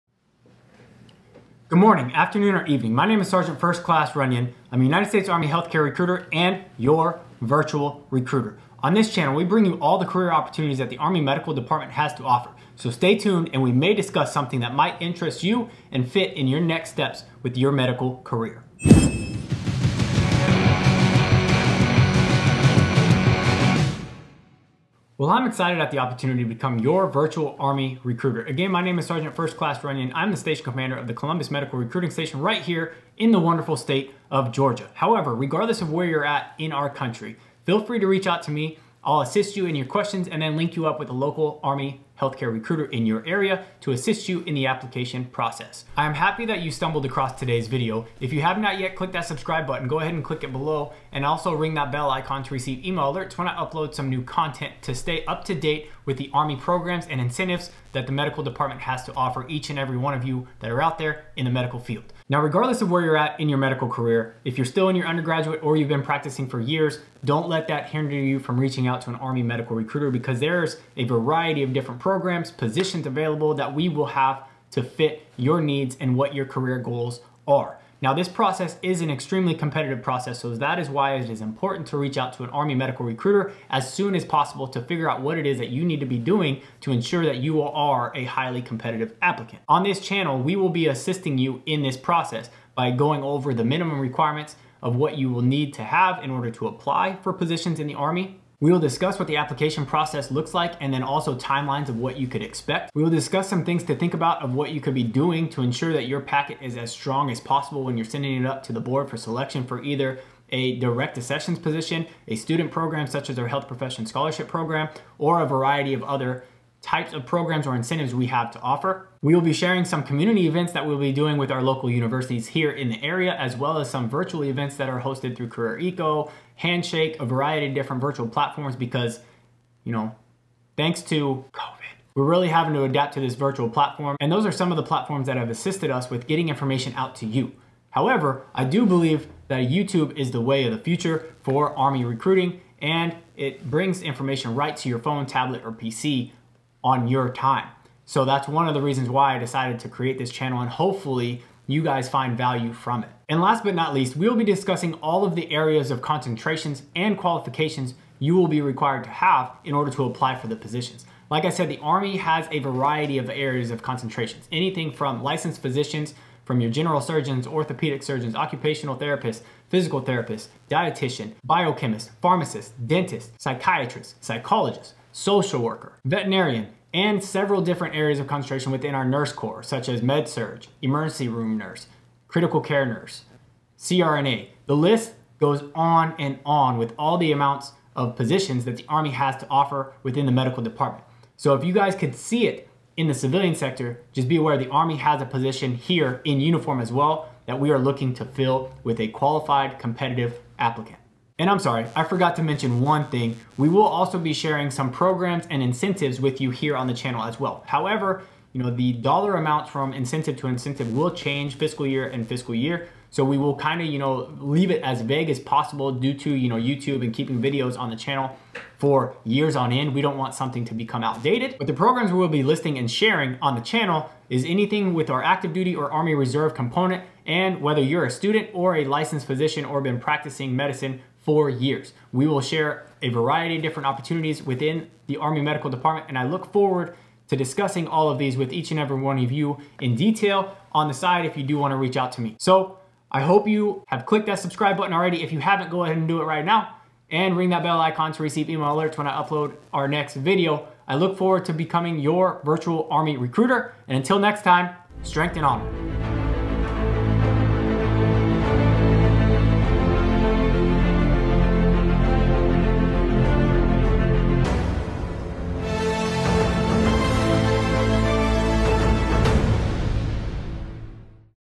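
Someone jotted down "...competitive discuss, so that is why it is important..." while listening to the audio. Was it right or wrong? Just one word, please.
wrong.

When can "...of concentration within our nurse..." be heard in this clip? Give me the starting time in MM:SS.
02:58.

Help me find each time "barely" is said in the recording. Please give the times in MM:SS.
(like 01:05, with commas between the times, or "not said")
not said.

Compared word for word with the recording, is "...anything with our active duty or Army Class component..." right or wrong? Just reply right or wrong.
wrong.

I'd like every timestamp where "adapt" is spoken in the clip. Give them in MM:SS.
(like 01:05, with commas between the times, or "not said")
02:12.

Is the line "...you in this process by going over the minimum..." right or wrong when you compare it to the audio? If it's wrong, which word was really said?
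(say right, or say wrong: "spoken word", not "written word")
right.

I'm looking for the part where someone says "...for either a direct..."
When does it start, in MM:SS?
01:49.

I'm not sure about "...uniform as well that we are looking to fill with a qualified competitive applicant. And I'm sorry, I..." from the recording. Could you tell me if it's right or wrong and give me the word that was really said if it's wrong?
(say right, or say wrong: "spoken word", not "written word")
right.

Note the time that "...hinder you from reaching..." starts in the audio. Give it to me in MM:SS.
01:07.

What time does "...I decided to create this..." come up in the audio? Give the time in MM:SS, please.
02:29.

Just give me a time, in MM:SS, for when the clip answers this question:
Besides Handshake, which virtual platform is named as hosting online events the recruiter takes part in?
02:05.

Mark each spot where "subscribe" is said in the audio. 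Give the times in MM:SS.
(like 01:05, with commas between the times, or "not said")
00:49, 04:04.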